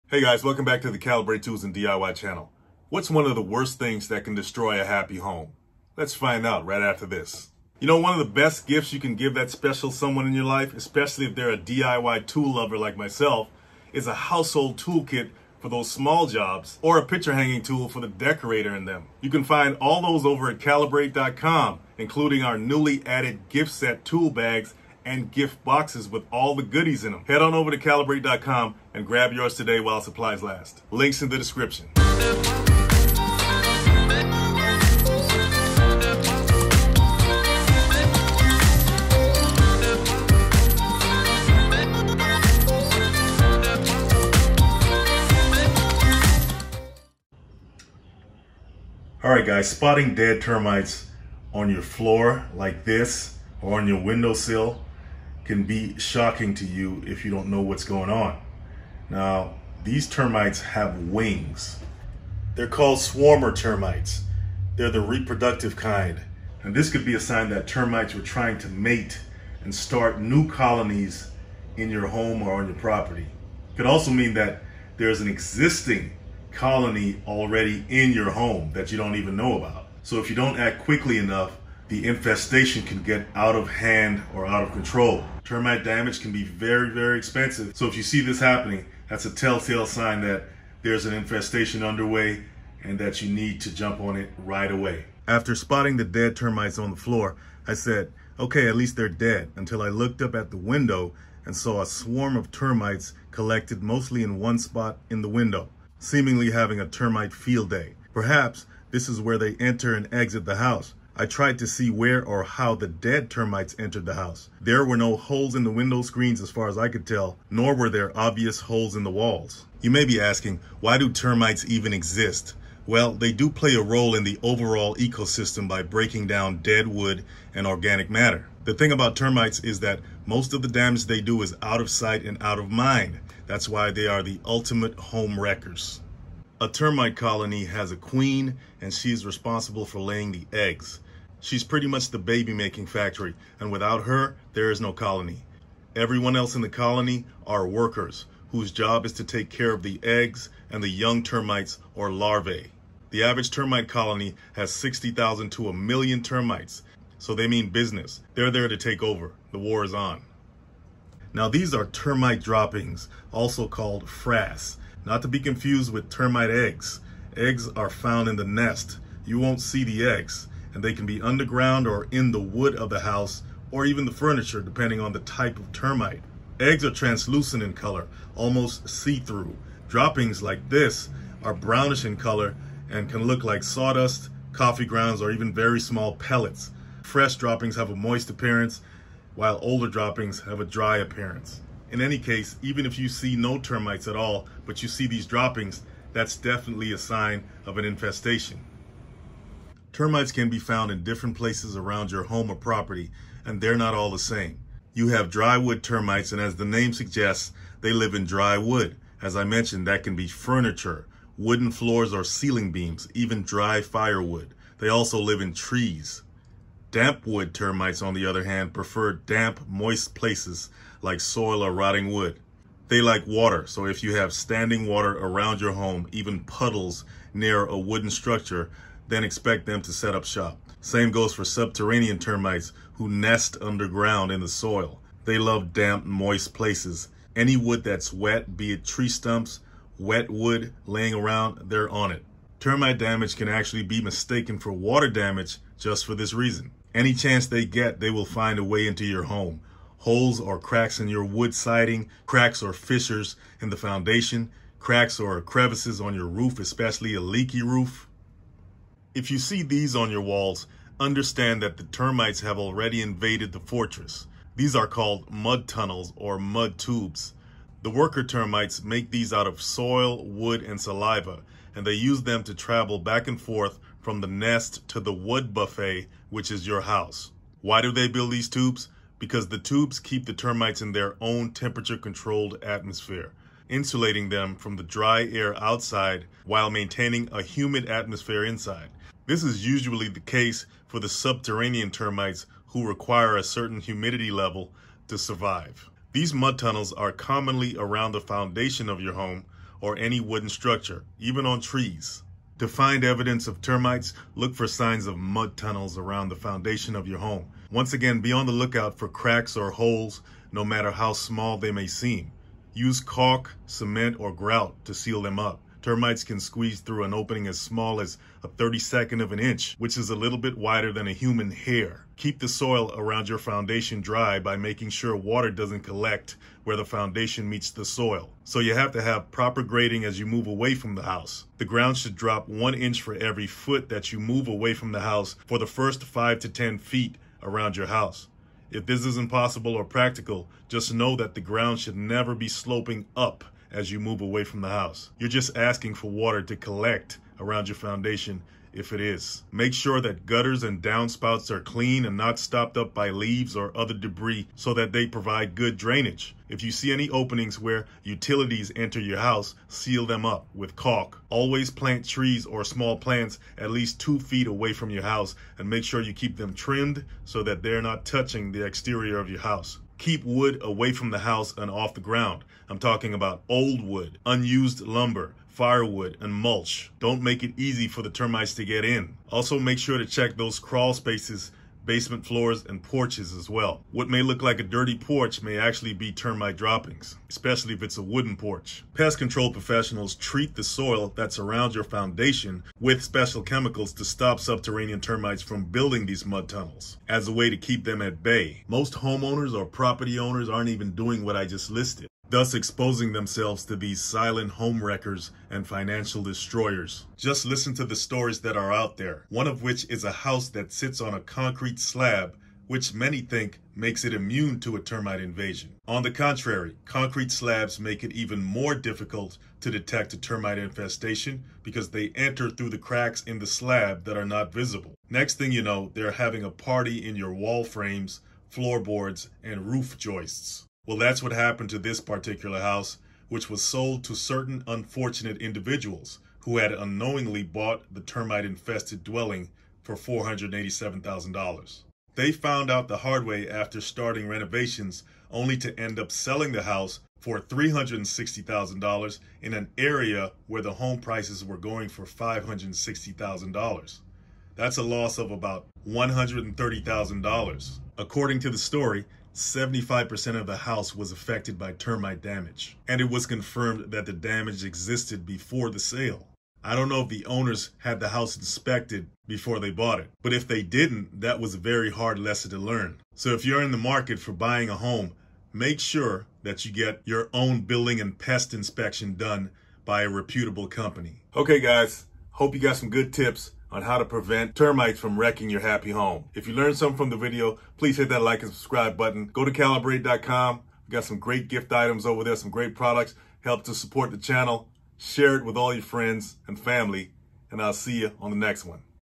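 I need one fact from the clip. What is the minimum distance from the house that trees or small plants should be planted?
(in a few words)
2 feet.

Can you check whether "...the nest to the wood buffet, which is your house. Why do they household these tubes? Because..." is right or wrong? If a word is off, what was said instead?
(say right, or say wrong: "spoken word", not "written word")
wrong: "build", not "household".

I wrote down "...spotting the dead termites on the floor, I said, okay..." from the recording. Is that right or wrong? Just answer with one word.
right.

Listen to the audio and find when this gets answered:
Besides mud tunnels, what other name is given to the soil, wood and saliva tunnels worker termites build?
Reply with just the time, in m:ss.
4:26.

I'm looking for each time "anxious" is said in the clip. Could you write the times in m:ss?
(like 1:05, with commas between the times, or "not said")
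not said.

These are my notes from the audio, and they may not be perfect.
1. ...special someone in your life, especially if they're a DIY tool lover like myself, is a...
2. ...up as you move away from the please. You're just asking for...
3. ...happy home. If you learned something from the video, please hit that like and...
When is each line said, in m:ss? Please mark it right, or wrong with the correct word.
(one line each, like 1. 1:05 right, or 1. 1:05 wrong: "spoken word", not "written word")
1. 0:09 right
2. 5:43 wrong: "house", not "please"
3. 8:05 right.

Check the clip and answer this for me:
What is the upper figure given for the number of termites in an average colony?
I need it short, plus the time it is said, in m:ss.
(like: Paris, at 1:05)
A million, at 2:35.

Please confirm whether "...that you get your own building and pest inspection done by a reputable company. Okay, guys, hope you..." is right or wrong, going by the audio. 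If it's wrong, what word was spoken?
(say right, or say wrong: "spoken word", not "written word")
right.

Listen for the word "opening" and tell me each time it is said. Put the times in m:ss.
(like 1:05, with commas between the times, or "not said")
5:17, 5:57.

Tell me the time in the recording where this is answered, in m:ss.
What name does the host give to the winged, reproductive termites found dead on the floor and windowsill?
1:02.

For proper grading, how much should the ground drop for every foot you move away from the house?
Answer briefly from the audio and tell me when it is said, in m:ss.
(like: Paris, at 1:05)
1 inch, at 5:32.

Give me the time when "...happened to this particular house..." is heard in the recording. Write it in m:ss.
7:11.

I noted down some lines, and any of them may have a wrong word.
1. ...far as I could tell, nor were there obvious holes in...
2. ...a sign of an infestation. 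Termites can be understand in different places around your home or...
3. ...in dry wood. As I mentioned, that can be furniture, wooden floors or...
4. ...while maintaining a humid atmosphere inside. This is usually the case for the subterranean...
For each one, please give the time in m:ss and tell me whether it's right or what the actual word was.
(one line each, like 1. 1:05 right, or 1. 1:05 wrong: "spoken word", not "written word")
1. 1:56 right
2. 3:16 wrong: "found", not "understand"
3. 3:28 right
4. 4:46 right.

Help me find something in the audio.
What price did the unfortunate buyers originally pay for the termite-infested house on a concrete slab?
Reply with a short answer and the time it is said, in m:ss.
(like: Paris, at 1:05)
$487,000, at 7:19.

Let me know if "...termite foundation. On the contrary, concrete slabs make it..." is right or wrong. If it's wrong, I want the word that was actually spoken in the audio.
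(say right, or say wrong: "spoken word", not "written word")
wrong: "invasion", not "foundation".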